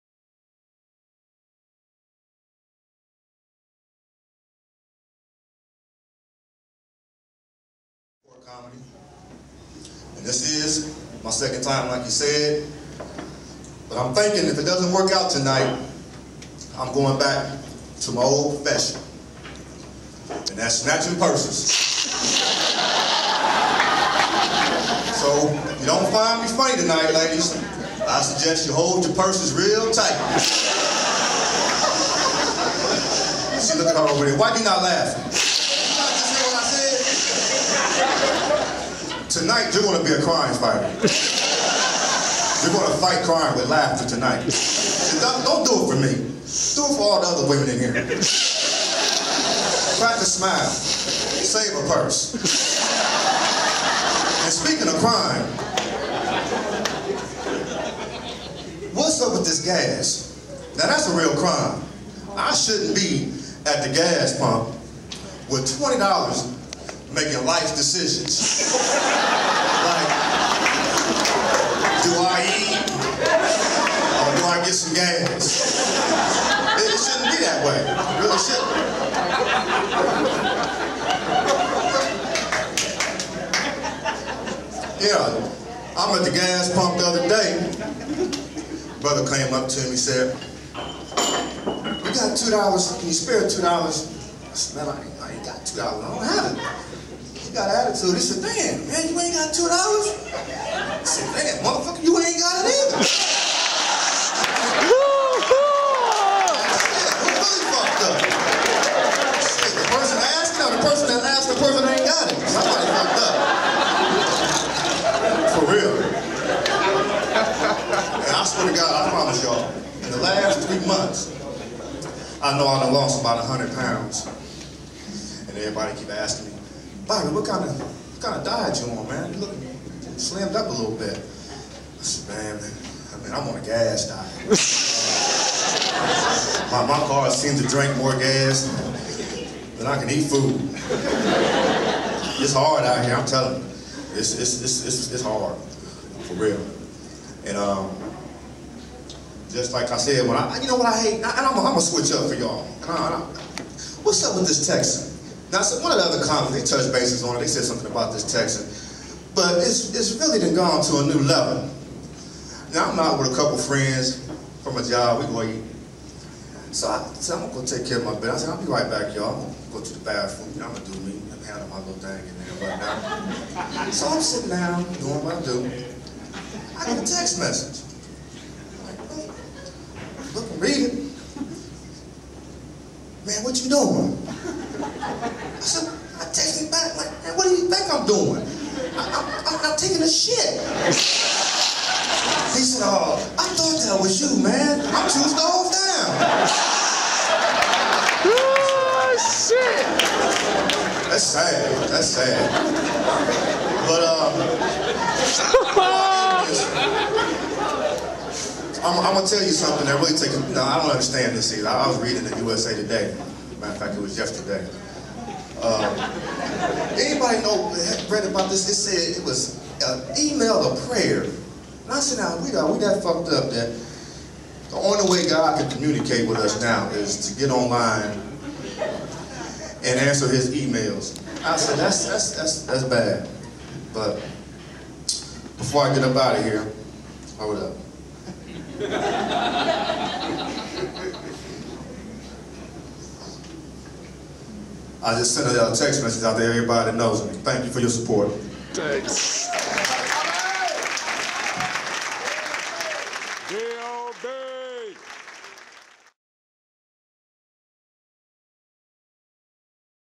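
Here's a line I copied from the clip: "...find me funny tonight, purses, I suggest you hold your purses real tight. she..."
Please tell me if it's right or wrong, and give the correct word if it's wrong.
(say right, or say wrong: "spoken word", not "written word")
wrong: "ladies", not "purses".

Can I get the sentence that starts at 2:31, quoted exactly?
I, and I'm going to switch up for y'all.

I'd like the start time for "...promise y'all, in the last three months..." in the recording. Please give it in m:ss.
1:59.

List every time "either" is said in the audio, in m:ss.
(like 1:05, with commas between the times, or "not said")
1:42, 3:31.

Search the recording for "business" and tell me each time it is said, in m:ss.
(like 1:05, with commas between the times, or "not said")
2:48.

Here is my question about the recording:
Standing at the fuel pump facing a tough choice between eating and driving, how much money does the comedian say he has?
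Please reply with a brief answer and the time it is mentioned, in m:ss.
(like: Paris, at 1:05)
$20, at 1:05.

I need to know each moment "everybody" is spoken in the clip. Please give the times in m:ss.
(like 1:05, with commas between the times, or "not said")
2:05, 4:06.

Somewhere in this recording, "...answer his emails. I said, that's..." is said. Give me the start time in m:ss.
3:49.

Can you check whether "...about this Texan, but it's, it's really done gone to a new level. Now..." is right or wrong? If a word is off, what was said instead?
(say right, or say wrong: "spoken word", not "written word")
right.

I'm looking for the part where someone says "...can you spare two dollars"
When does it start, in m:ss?
1:32.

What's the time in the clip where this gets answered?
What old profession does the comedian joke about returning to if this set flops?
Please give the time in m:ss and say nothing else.
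0:20.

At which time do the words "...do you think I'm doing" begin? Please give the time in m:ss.
3:07.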